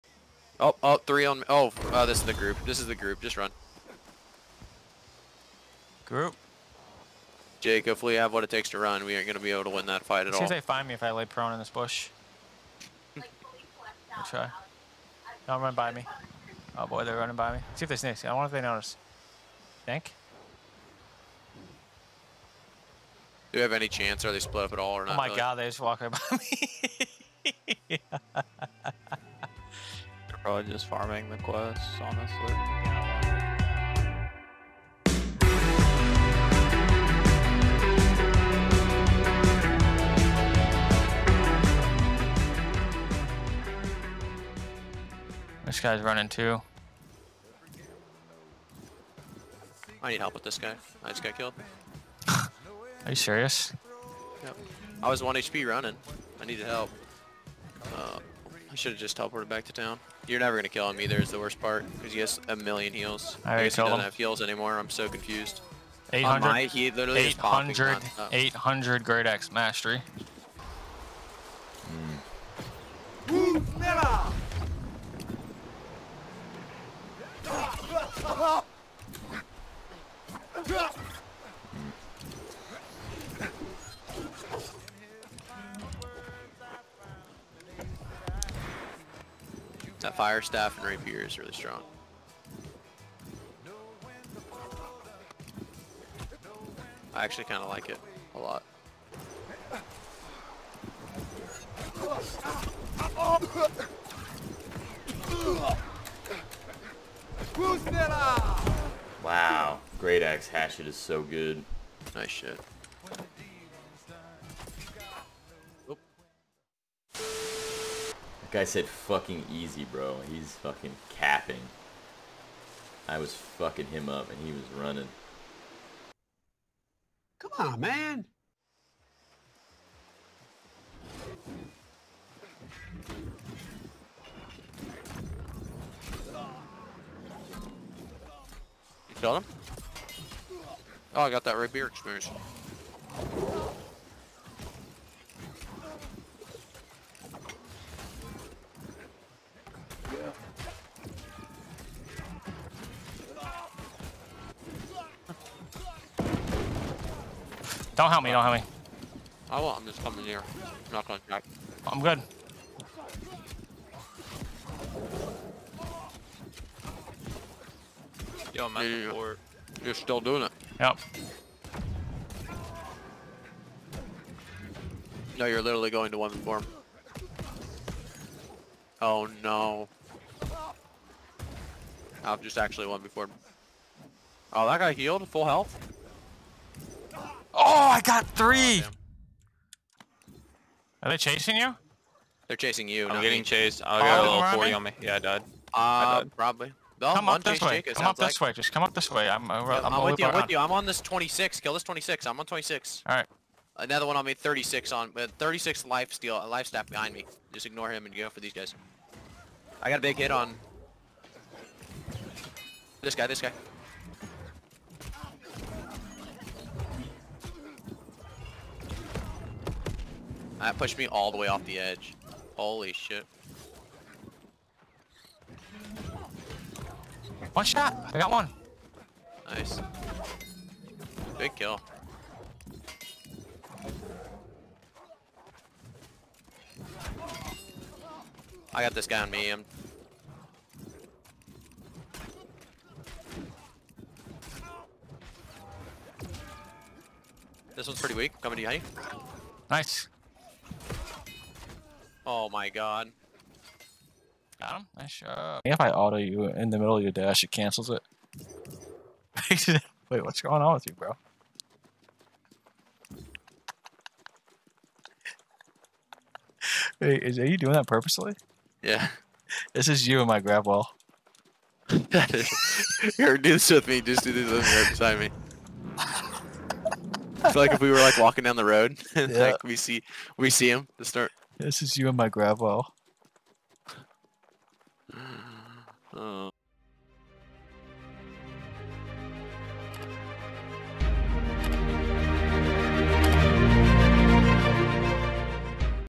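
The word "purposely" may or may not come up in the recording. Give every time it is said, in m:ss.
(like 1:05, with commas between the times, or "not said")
4:27.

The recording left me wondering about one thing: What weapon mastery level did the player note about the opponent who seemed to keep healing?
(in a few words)
800.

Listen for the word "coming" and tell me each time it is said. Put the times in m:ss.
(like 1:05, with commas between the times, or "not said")
2:40, 4:08.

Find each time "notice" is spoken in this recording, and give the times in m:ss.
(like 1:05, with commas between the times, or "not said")
0:18.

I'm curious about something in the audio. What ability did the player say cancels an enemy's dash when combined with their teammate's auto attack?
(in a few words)
Gravity Well.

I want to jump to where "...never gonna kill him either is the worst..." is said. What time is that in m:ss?
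1:00.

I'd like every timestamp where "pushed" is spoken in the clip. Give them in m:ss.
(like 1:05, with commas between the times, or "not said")
3:40.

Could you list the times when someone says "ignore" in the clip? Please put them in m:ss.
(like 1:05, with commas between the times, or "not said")
3:27.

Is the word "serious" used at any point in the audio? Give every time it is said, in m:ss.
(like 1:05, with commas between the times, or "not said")
0:53.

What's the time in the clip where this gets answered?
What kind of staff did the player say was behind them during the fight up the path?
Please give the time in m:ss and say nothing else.
3:26.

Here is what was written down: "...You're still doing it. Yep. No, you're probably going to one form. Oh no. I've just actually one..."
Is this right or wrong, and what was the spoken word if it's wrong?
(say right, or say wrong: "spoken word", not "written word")
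wrong: "literally", not "probably".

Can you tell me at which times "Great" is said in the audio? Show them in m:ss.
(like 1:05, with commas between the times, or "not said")
1:09, 1:49.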